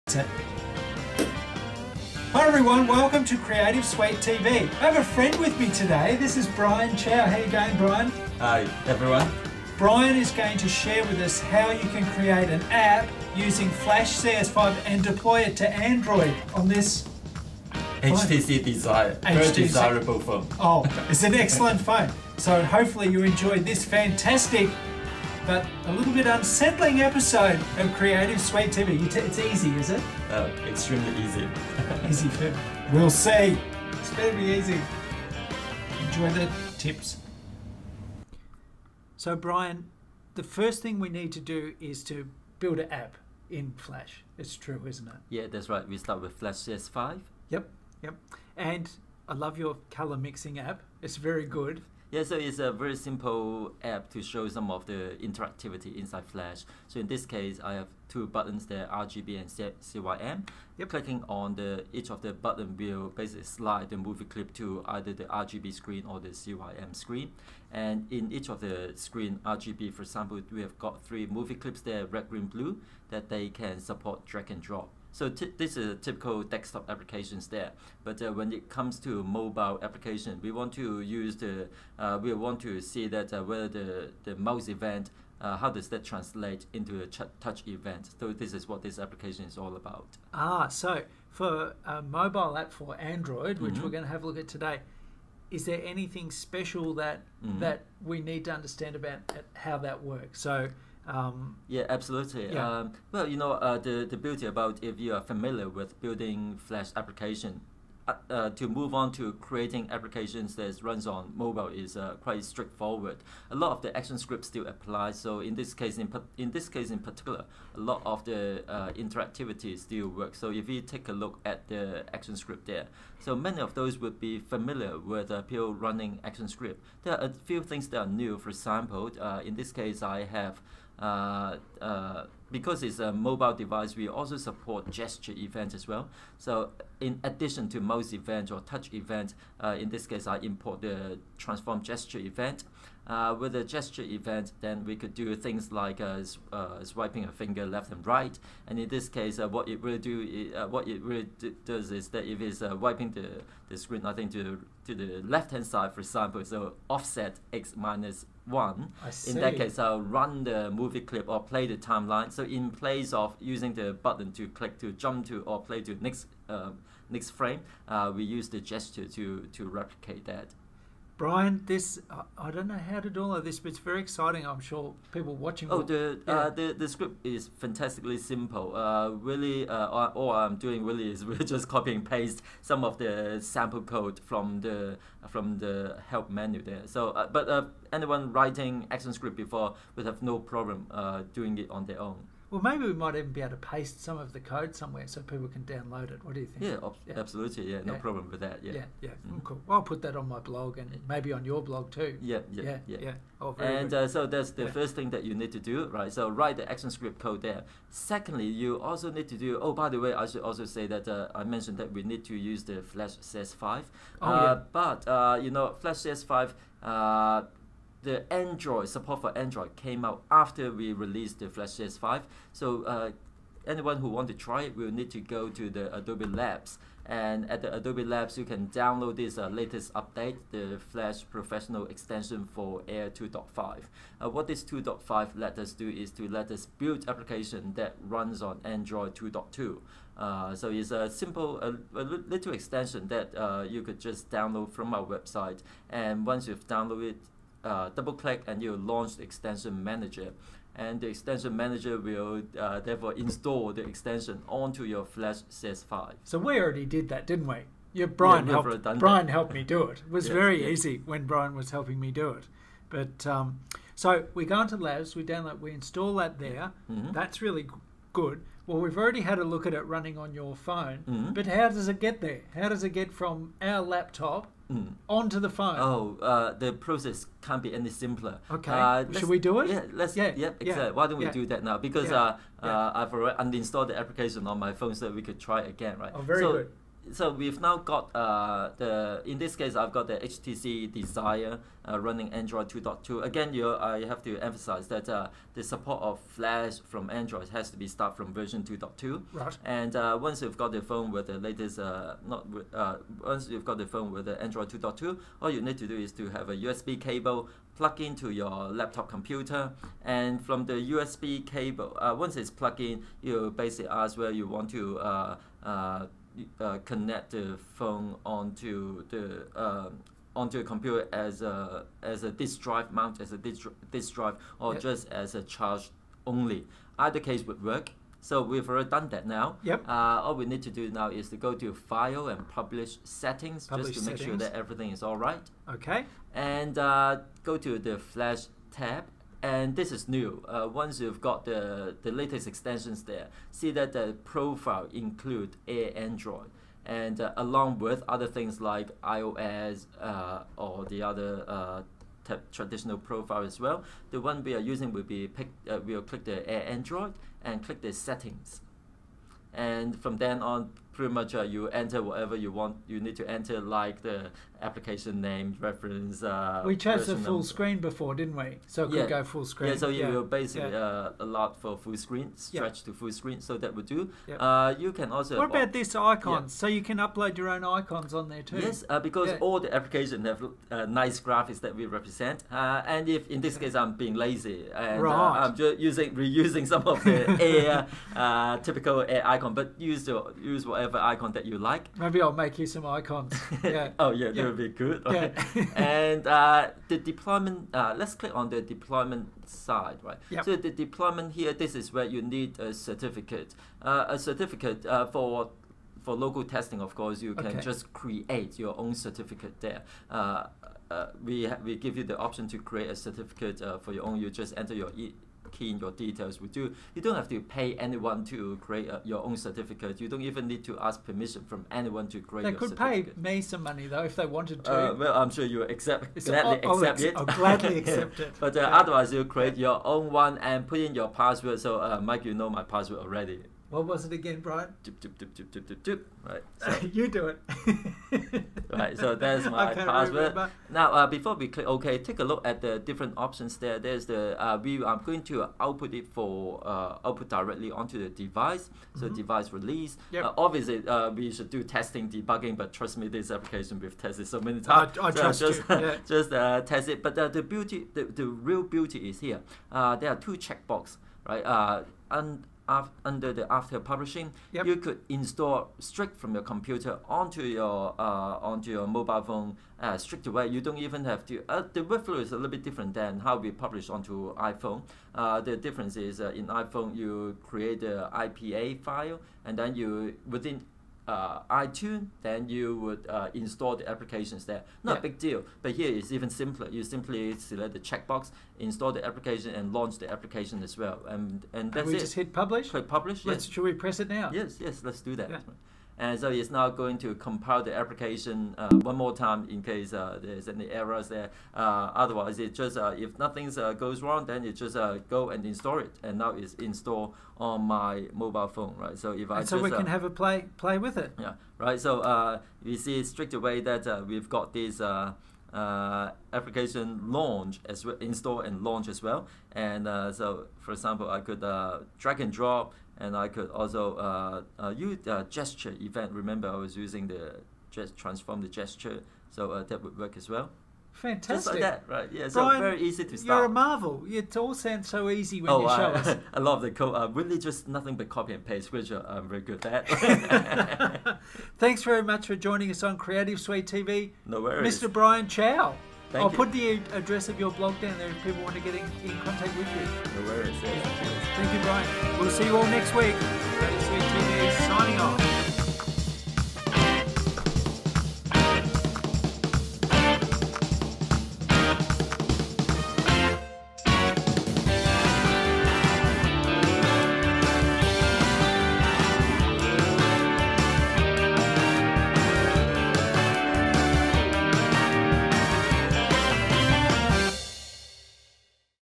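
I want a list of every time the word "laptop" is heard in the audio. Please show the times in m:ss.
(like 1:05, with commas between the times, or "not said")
4:33, 5:08.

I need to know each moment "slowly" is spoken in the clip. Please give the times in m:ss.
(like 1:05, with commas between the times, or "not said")
not said.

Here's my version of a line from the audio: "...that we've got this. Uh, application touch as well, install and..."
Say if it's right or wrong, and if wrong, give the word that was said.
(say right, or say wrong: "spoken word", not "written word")
wrong: "launch", not "touch".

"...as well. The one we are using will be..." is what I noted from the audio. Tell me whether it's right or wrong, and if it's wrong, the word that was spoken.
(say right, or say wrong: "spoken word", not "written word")
right.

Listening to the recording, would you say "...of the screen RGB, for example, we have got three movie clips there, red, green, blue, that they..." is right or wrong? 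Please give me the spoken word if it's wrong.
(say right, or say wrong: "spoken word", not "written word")
right.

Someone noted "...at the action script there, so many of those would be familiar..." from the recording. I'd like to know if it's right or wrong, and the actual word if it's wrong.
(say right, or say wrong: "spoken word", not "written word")
right.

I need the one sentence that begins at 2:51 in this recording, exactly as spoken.
Brian, this I, I don't know how to do all of this, but it's very exciting.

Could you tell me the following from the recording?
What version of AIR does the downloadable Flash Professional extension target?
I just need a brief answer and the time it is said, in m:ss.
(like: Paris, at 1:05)
2.5, at 3:52.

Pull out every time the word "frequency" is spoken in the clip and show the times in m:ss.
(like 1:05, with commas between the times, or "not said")
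not said.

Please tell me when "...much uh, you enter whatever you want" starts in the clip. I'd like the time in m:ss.
6:01.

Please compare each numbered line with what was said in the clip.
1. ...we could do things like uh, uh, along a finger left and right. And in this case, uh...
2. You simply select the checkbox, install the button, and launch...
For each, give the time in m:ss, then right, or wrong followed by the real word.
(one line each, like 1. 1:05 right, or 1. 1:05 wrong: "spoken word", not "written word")
1. 2:24 wrong: "swiping", not "along"
2. 8:06 wrong: "application", not "button".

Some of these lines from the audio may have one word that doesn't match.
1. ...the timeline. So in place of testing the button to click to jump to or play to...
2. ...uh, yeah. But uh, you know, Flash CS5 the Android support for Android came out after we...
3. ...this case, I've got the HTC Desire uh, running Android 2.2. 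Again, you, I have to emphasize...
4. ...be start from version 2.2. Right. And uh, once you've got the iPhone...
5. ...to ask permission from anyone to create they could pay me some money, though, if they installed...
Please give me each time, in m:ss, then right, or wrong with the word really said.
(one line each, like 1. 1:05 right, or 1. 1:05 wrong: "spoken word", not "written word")
1. 2:41 wrong: "using", not "testing"
2. 3:34 right
3. 4:49 right
4. 4:57 wrong: "phone", not "iPhone"
5. 7:00 wrong: "wanted", not "installed".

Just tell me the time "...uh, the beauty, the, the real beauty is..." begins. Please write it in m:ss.
7:37.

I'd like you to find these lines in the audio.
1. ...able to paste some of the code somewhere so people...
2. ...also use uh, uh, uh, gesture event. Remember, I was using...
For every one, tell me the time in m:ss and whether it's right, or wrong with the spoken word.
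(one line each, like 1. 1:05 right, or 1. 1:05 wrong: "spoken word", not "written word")
1. 3:13 right
2. 8:43 right.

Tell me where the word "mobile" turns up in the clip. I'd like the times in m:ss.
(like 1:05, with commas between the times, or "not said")
1:19, 1:32, 1:51, 2:13, 7:48, 8:28.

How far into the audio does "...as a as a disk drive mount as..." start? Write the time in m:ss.
5:21.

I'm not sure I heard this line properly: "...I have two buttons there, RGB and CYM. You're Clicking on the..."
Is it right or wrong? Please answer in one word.
right.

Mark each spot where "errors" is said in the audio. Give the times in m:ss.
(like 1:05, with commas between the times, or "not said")
8:20.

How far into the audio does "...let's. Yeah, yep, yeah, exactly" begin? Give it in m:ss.
4:39.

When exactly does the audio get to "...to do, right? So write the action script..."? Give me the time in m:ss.
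3:25.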